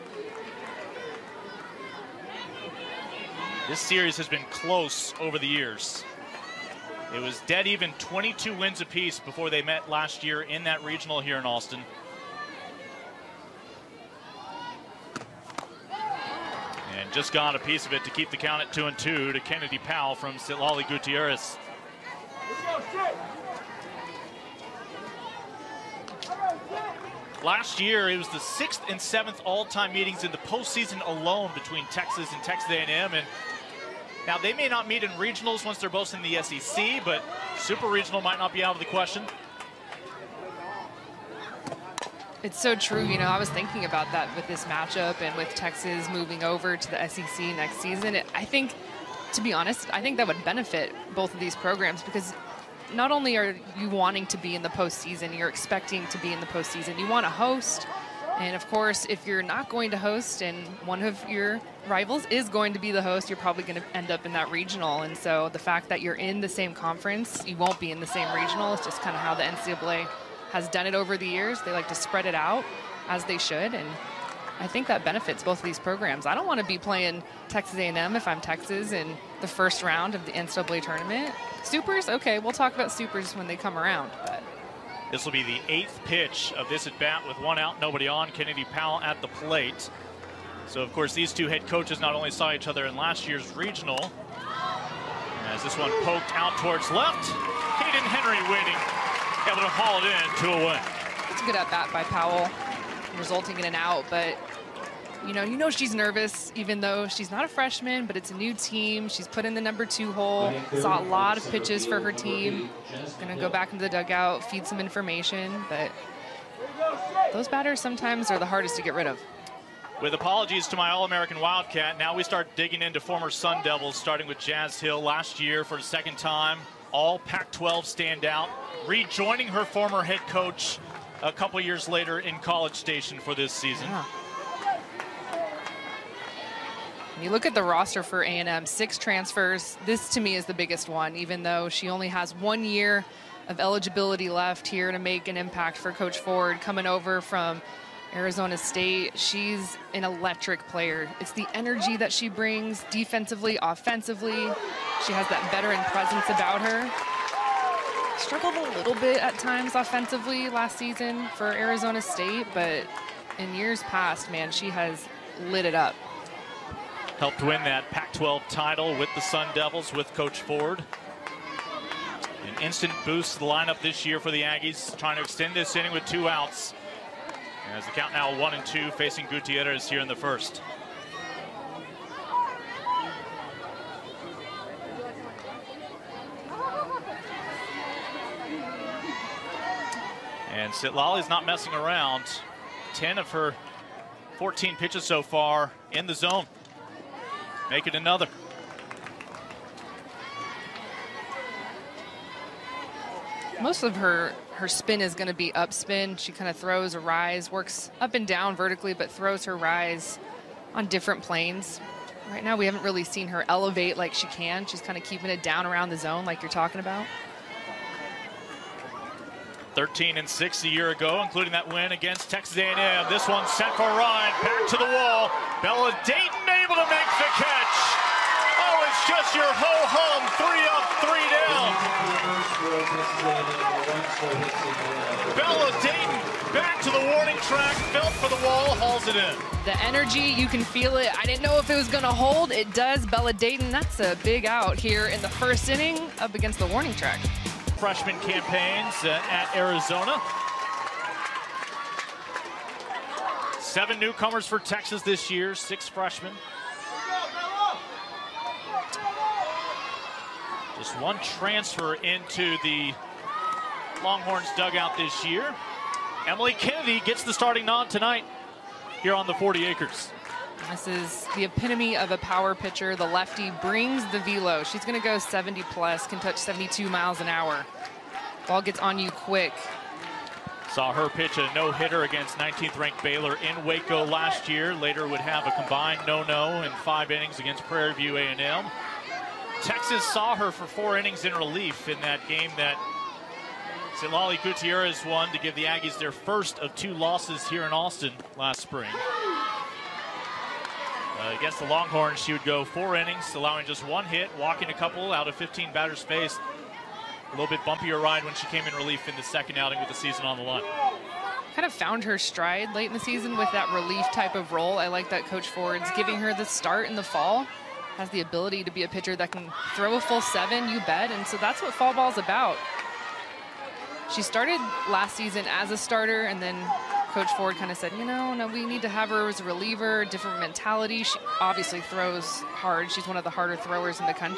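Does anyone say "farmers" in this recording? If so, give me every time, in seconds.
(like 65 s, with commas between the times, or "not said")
not said.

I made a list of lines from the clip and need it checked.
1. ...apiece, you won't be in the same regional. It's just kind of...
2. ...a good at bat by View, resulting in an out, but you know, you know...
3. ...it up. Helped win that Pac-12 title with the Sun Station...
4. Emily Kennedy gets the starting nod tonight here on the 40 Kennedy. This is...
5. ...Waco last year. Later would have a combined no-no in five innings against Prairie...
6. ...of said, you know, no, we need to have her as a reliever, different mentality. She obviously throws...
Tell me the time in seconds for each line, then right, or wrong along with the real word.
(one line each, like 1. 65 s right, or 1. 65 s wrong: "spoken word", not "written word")
1. 66 s wrong: "conference", not "apiece"
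2. 101 s wrong: "Powell", not "View"
3. 165 s wrong: "Devils", not "Station"
4. 266 s wrong: "Acres", not "Kennedy"
5. 283 s right
6. 327 s right.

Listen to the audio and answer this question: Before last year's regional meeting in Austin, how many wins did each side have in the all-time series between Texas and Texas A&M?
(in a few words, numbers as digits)
22.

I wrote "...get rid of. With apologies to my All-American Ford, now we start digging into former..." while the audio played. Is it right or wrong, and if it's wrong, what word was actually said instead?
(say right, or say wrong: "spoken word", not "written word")
wrong: "Wildcat", not "Ford".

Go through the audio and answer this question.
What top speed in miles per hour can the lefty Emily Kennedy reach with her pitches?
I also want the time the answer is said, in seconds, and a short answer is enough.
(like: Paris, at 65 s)
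72, at 276 s.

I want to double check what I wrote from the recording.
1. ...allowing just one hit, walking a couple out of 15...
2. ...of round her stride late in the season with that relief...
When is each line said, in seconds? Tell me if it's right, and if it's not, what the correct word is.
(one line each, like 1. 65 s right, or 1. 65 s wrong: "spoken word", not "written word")
1. 303 s right
2. 311 s wrong: "found", not "round".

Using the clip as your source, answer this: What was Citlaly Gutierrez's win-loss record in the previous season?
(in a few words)
13 and 6.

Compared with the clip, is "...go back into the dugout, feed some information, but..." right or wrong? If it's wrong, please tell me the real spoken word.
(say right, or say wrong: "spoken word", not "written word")
right.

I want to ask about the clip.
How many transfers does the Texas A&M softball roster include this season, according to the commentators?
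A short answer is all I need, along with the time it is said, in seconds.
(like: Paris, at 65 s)
6, at 138 s.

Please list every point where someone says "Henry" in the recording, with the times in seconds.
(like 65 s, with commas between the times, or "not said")
98 s.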